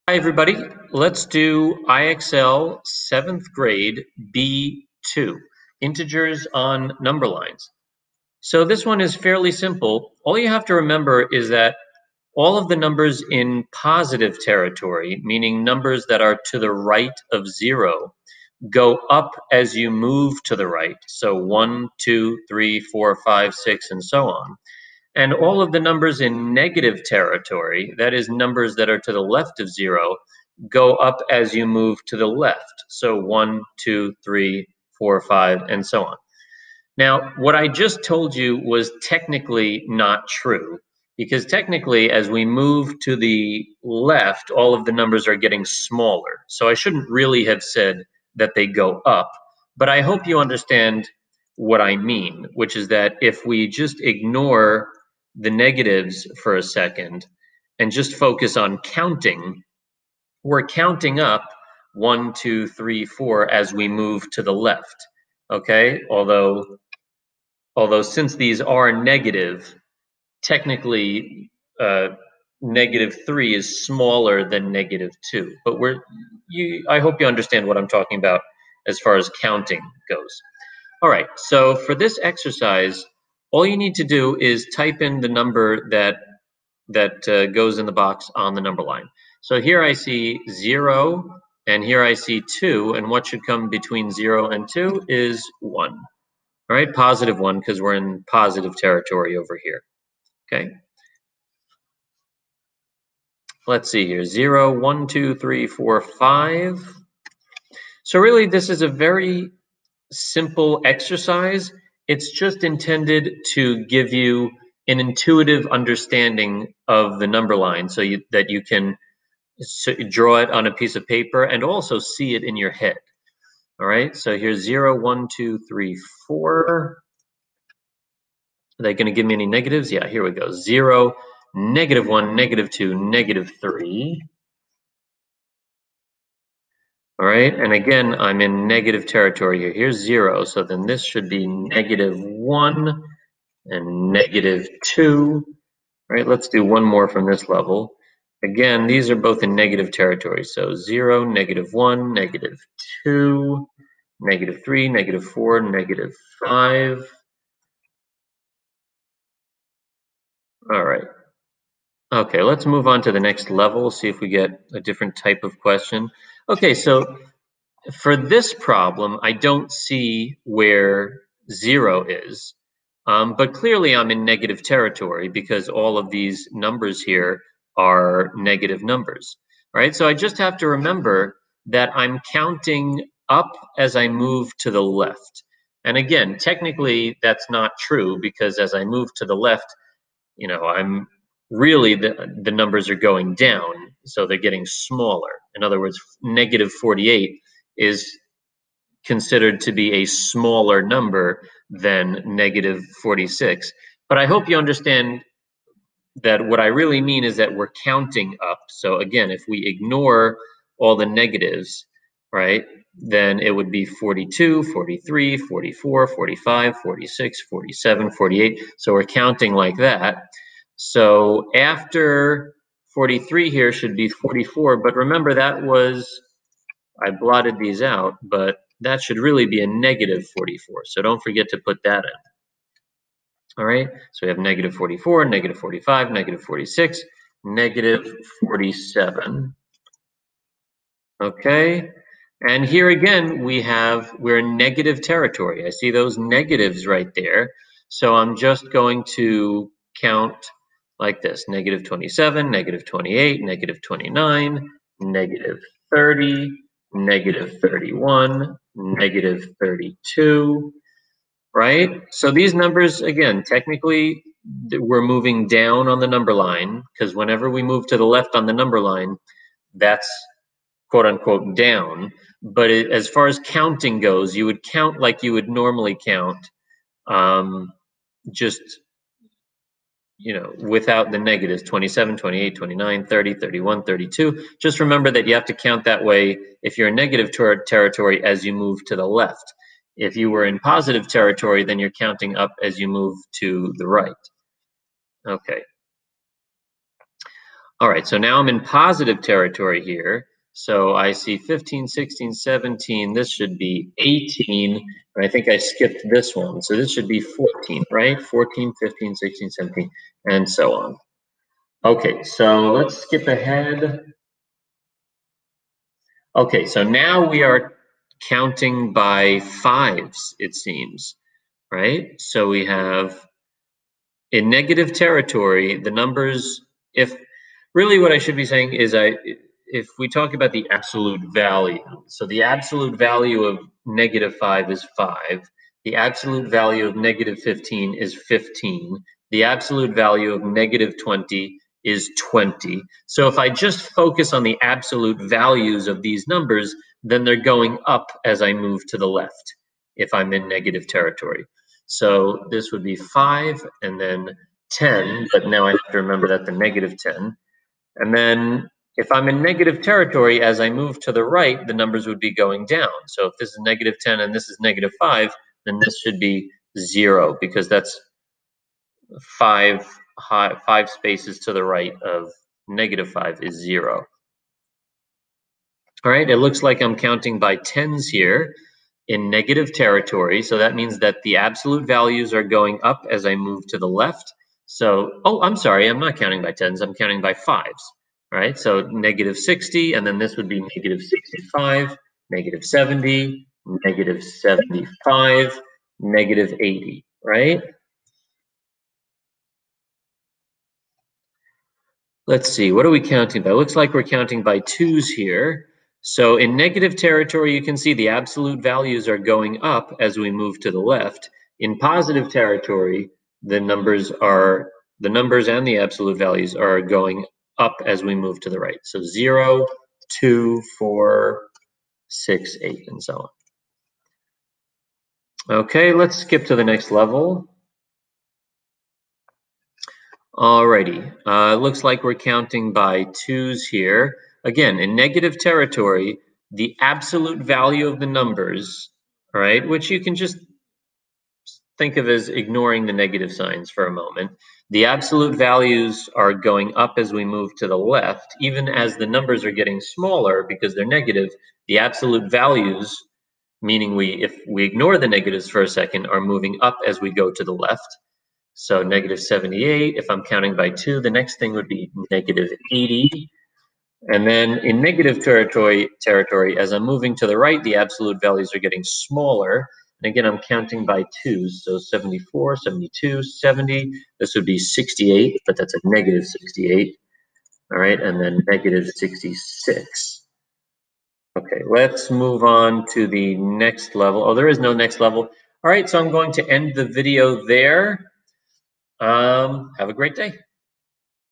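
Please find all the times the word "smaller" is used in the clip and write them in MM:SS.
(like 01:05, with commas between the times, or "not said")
00:45, 01:13, 03:14, 03:20, 07:29, 07:48.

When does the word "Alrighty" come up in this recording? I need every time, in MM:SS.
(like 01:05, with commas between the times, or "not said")
07:10.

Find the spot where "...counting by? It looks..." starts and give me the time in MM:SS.
06:43.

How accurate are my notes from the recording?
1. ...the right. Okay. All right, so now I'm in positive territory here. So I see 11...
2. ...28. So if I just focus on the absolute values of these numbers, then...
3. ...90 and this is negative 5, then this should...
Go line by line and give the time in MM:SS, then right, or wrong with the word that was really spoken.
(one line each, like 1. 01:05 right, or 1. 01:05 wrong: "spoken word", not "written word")
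1. 04:53 wrong: "15", not "11"
2. 05:42 wrong: "20", not "28"
3. 06:04 wrong: "10", not "90".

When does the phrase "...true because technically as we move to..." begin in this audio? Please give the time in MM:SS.
00:40.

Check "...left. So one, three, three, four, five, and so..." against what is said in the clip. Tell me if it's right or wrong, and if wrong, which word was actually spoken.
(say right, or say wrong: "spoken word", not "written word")
wrong: "two", not "three".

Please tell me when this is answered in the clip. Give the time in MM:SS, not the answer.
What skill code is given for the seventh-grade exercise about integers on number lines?
00:04.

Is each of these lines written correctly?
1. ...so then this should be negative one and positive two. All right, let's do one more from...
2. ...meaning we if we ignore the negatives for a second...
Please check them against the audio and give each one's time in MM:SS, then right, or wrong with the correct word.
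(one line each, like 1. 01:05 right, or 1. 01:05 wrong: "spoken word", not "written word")
1. 02:20 wrong: "negative", not "positive"
2. 07:33 right.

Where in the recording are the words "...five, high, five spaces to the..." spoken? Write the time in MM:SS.
06:09.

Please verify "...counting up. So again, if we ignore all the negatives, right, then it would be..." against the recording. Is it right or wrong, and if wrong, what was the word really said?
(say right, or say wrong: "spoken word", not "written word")
right.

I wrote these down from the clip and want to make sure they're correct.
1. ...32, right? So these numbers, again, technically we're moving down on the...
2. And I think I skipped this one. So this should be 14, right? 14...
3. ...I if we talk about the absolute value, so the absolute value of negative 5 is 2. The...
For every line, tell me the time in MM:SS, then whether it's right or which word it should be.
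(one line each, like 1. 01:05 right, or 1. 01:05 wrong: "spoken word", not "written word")
1. 04:19 right
2. 05:05 right
3. 05:28 wrong: "5", not "2".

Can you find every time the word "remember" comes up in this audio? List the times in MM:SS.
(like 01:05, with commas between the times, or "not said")
00:10, 03:00, 03:44, 04:44, 05:55.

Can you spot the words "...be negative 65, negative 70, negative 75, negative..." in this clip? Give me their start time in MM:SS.
06:30.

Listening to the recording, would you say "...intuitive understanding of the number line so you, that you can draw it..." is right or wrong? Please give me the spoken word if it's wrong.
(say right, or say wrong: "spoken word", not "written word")
right.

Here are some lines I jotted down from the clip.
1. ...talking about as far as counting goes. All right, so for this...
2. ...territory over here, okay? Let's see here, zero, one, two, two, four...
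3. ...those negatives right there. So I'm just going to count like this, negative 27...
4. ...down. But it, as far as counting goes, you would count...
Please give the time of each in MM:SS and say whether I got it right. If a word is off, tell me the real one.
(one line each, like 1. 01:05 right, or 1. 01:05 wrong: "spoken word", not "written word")
1. 01:17 right
2. 01:38 wrong: "three", not "two"
3. 04:05 right
4. 04:31 right.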